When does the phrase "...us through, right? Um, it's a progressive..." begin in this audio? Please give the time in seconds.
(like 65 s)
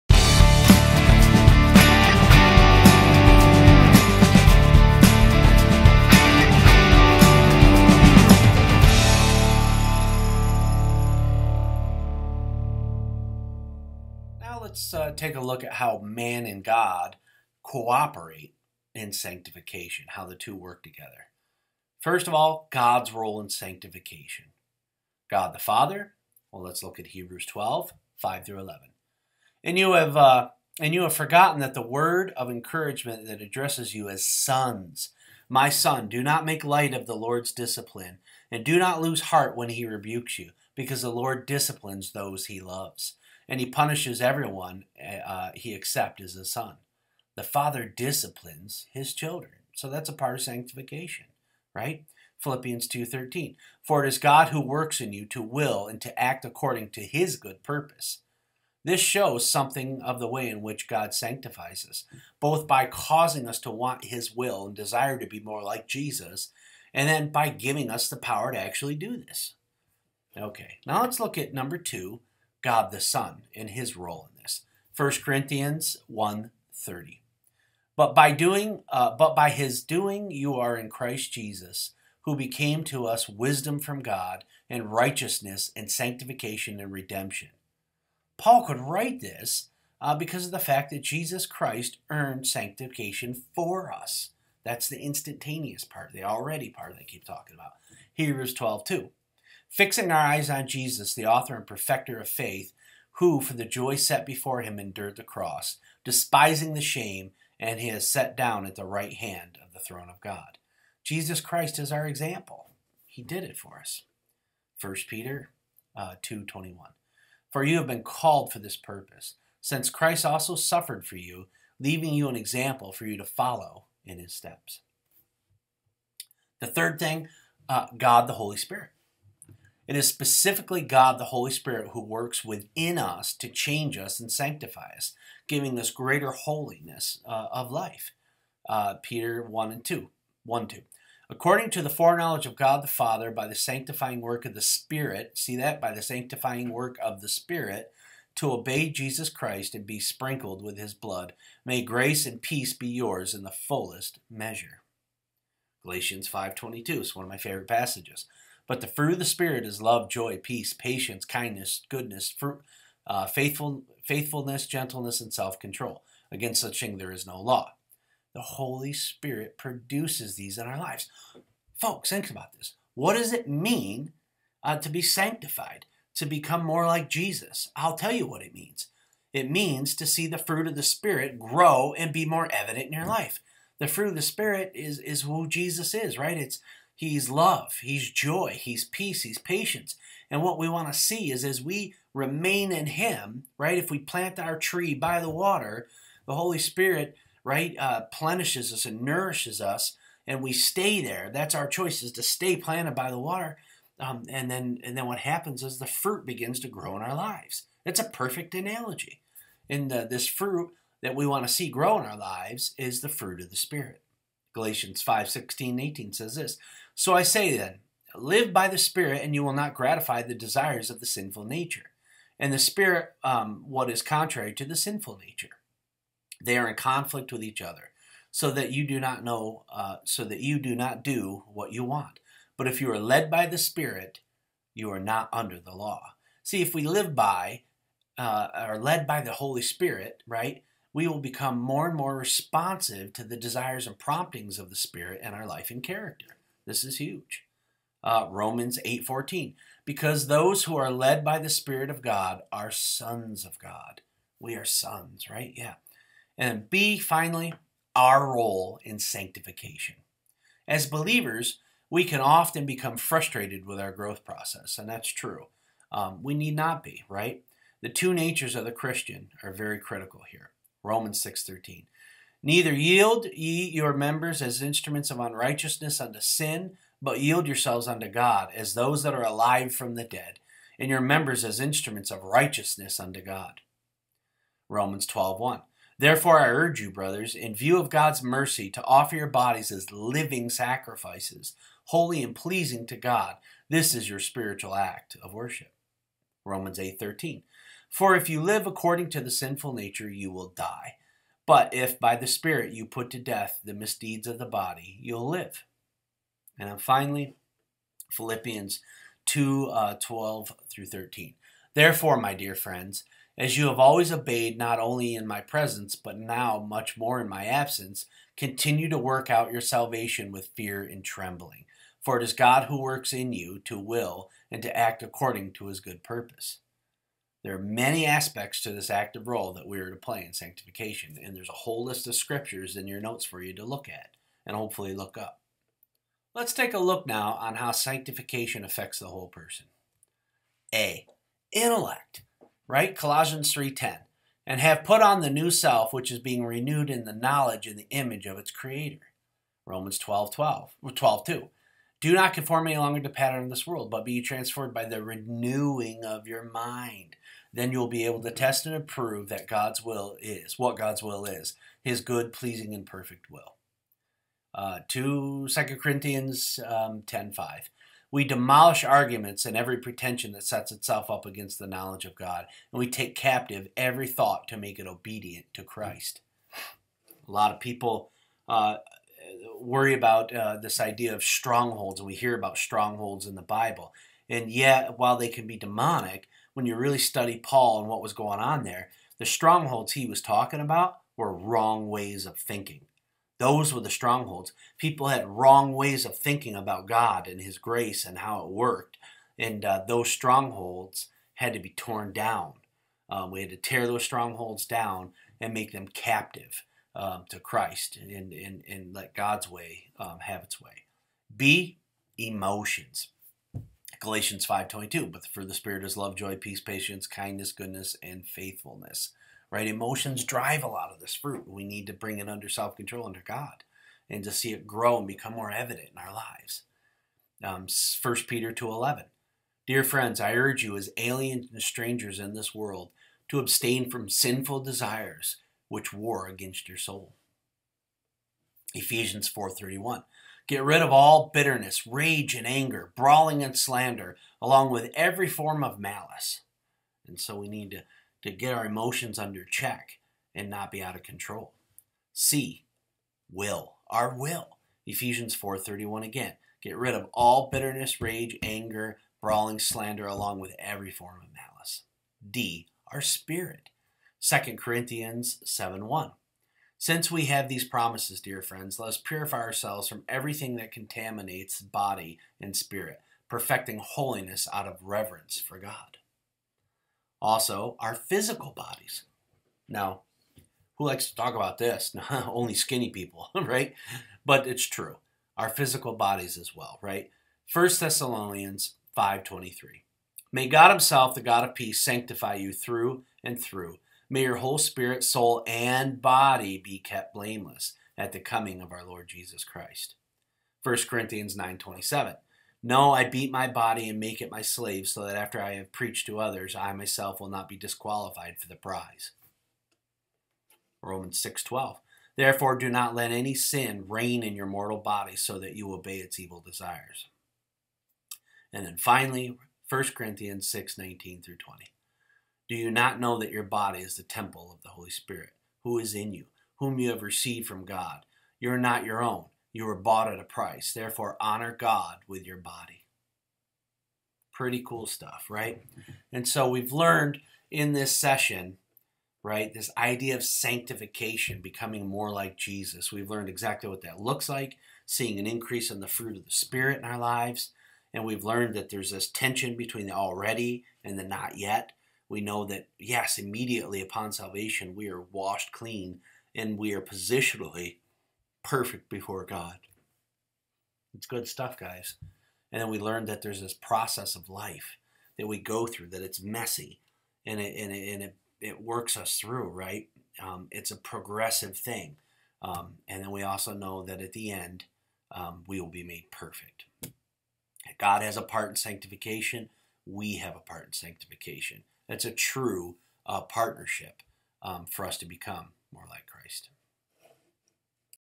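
568 s.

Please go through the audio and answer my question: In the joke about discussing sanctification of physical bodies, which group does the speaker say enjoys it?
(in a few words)
Skinny people.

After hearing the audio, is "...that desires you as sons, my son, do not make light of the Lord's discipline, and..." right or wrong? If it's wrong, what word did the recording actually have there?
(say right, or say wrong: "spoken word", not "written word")
wrong: "addresses", not "desires".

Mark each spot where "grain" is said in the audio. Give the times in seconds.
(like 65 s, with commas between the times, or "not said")
not said.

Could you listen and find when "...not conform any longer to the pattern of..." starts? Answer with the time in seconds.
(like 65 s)
352 s.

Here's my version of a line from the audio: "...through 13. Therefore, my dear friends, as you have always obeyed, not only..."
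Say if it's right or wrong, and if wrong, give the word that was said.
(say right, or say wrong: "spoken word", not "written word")
right.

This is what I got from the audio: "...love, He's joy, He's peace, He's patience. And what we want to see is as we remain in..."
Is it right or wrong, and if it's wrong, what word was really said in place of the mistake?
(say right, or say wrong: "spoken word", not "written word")
right.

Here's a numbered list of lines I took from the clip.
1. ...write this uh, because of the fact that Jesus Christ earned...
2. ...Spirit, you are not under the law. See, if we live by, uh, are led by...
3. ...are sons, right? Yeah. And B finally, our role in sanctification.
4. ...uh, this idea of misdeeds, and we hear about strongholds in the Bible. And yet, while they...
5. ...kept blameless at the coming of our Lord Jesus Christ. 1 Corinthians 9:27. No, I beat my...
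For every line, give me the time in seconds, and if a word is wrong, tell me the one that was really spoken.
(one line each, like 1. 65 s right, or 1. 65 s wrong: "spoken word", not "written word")
1. 88 s right
2. 233 s right
3. 254 s right
4. 380 s wrong: "strongholds", not "misdeeds"
5. 496 s right.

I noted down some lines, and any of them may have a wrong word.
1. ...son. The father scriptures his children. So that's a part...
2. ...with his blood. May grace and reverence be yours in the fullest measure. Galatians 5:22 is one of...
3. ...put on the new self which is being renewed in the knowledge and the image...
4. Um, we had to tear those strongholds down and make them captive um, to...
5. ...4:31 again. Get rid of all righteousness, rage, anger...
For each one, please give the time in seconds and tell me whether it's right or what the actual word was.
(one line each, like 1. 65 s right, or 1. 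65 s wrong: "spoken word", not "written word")
1. 46 s wrong: "disciplines", not "scriptures"
2. 150 s wrong: "peace", not "reverence"
3. 344 s right
4. 403 s right
5. 455 s wrong: "bitterness", not "righteousness".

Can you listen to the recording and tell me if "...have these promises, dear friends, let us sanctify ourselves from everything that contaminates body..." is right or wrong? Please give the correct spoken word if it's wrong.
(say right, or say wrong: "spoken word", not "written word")
wrong: "purify", not "sanctify".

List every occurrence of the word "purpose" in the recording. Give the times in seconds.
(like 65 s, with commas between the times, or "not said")
57 s, 118 s, 326 s.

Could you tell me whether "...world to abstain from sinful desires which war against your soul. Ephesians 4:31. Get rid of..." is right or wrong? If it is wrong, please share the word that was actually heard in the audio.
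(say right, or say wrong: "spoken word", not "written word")
right.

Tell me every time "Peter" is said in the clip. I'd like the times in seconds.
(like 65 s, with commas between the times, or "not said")
115 s, 139 s, 428 s.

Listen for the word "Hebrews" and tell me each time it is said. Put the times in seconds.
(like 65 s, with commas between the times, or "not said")
27 s, 98 s.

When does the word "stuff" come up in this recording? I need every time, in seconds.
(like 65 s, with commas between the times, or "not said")
534 s, 561 s.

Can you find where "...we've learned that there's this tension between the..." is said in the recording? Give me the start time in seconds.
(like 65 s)
548 s.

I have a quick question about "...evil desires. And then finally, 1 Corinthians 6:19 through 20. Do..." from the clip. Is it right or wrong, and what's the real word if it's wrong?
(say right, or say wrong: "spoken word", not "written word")
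right.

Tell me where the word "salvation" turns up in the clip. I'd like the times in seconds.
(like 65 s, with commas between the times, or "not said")
319 s, 554 s.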